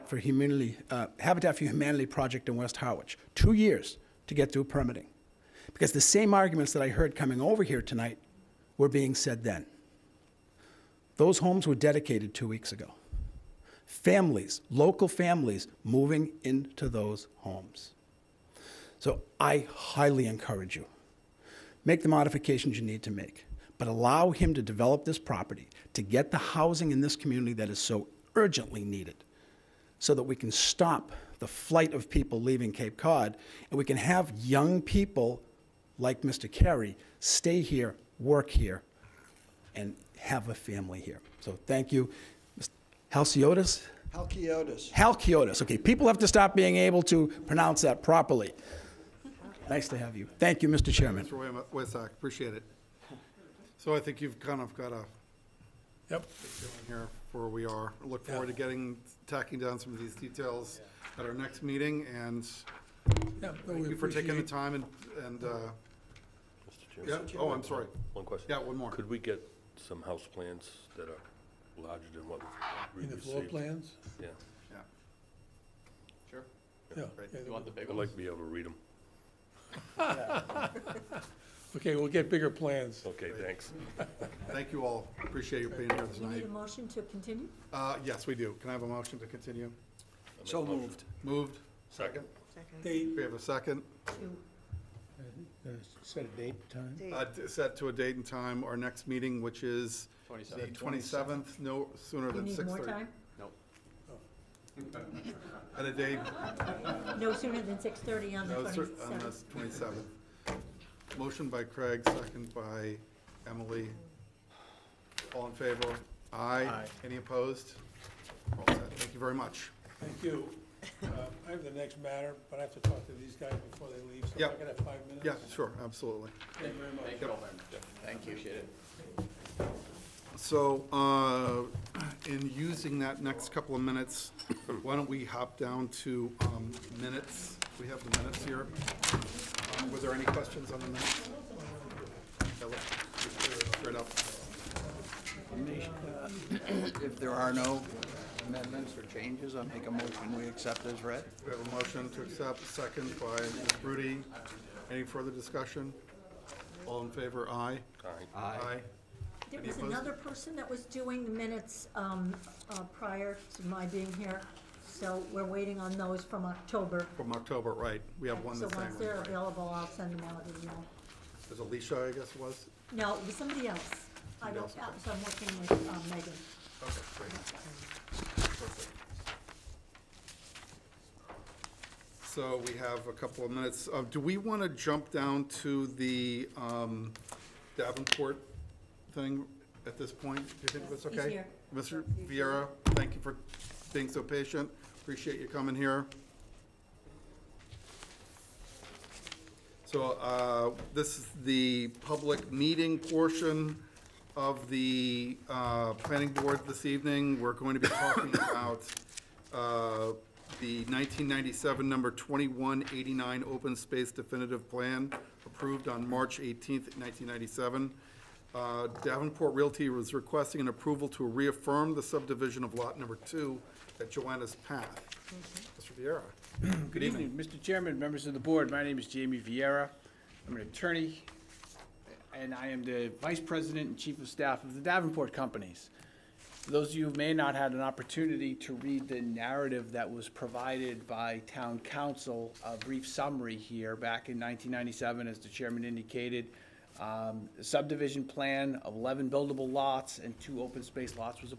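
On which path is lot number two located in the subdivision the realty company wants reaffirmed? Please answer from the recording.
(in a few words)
Joanna's Path.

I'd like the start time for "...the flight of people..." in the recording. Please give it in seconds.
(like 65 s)
31 s.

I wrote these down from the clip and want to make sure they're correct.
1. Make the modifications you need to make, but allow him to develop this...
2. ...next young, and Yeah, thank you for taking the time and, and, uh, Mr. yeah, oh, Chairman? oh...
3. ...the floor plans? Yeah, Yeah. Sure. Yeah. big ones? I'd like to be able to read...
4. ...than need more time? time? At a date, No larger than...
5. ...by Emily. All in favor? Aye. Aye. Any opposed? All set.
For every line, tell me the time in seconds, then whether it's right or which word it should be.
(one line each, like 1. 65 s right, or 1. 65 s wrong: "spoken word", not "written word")
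1. 21 s right
2. 61 s wrong: "meeting", not "young"
3. 73 s right
4. 102 s wrong: "sooner", not "larger"
5. 112 s right.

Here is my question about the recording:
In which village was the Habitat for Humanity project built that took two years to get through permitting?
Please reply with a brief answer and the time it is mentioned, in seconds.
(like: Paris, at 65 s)
West Harwich, at 2 s.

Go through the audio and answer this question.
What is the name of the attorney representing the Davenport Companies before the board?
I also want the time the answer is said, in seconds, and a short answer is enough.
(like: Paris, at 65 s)
Jamie Vieira, at 229 s.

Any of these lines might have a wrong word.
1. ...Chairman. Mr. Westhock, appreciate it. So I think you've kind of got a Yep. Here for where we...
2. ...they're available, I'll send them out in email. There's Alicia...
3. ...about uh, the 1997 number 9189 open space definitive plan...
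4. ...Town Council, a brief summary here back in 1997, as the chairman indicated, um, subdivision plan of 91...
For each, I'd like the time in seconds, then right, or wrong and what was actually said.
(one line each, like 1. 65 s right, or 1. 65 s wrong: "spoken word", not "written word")
1. 50 s right
2. 168 s right
3. 208 s wrong: "2189", not "9189"
4. 241 s wrong: "11", not "91".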